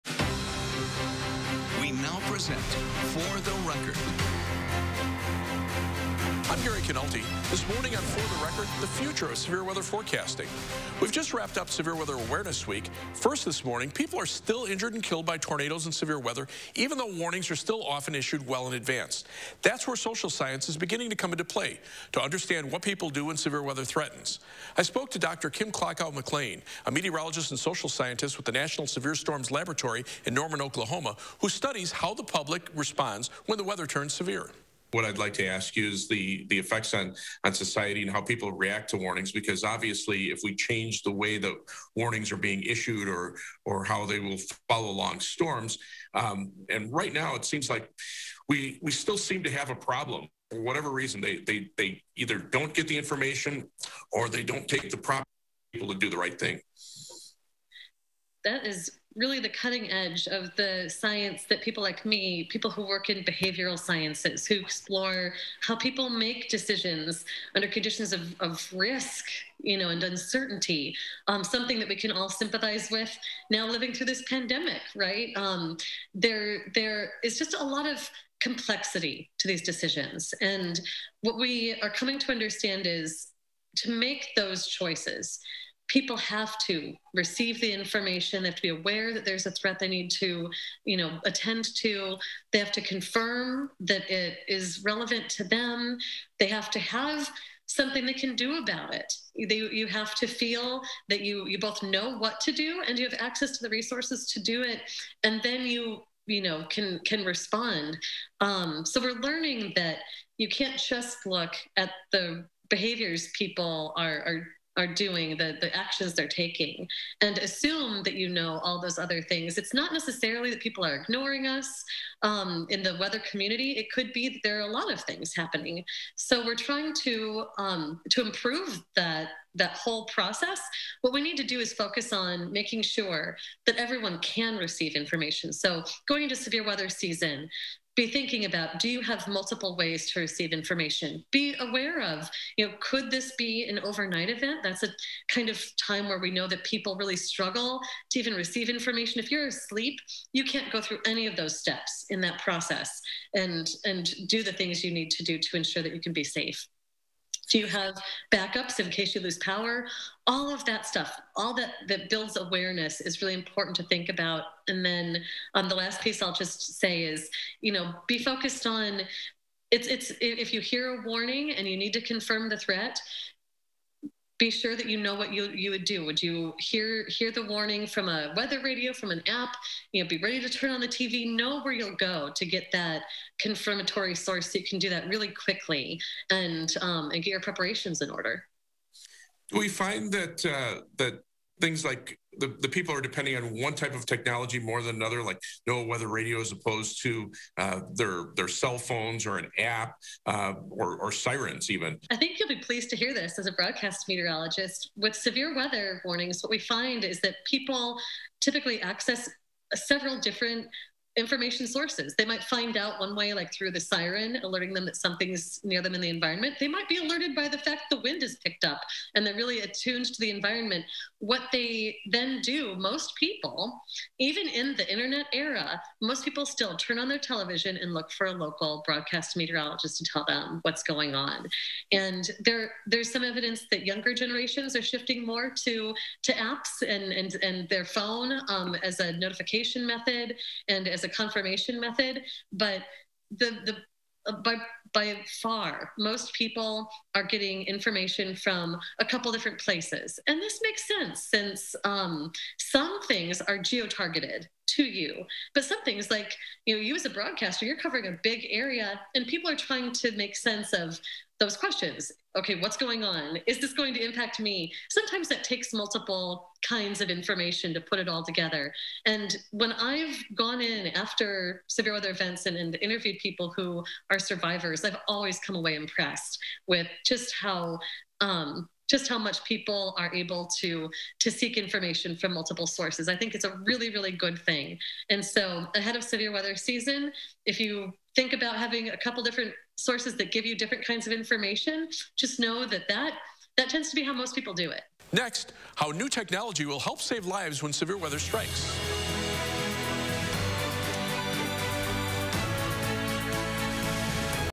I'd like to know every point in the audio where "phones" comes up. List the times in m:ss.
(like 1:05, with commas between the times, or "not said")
3:18, 3:57.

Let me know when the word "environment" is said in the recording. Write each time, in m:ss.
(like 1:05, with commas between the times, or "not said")
3:36, 3:40.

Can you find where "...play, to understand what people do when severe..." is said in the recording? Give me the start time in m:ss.
0:21.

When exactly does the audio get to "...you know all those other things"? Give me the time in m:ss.
1:58.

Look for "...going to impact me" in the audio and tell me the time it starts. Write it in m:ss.
4:23.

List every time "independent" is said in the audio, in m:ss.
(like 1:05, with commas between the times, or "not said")
not said.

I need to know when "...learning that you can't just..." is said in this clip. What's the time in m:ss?
1:49.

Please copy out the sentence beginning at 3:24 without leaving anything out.
With severe weather warnings, what we find is that people typically access several different information sources.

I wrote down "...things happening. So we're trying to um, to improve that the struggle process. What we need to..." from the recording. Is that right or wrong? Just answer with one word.
wrong.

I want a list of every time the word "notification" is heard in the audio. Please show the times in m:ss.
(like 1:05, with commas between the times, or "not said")
3:59.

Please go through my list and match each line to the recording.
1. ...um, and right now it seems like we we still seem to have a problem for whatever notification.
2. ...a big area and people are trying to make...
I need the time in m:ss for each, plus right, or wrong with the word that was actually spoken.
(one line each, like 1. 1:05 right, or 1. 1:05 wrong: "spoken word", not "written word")
1. 0:46 wrong: "reason", not "notification"
2. 4:18 right.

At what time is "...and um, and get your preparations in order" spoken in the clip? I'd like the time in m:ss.
3:06.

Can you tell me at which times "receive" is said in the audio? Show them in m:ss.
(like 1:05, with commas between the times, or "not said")
1:27, 2:14, 2:20, 2:28.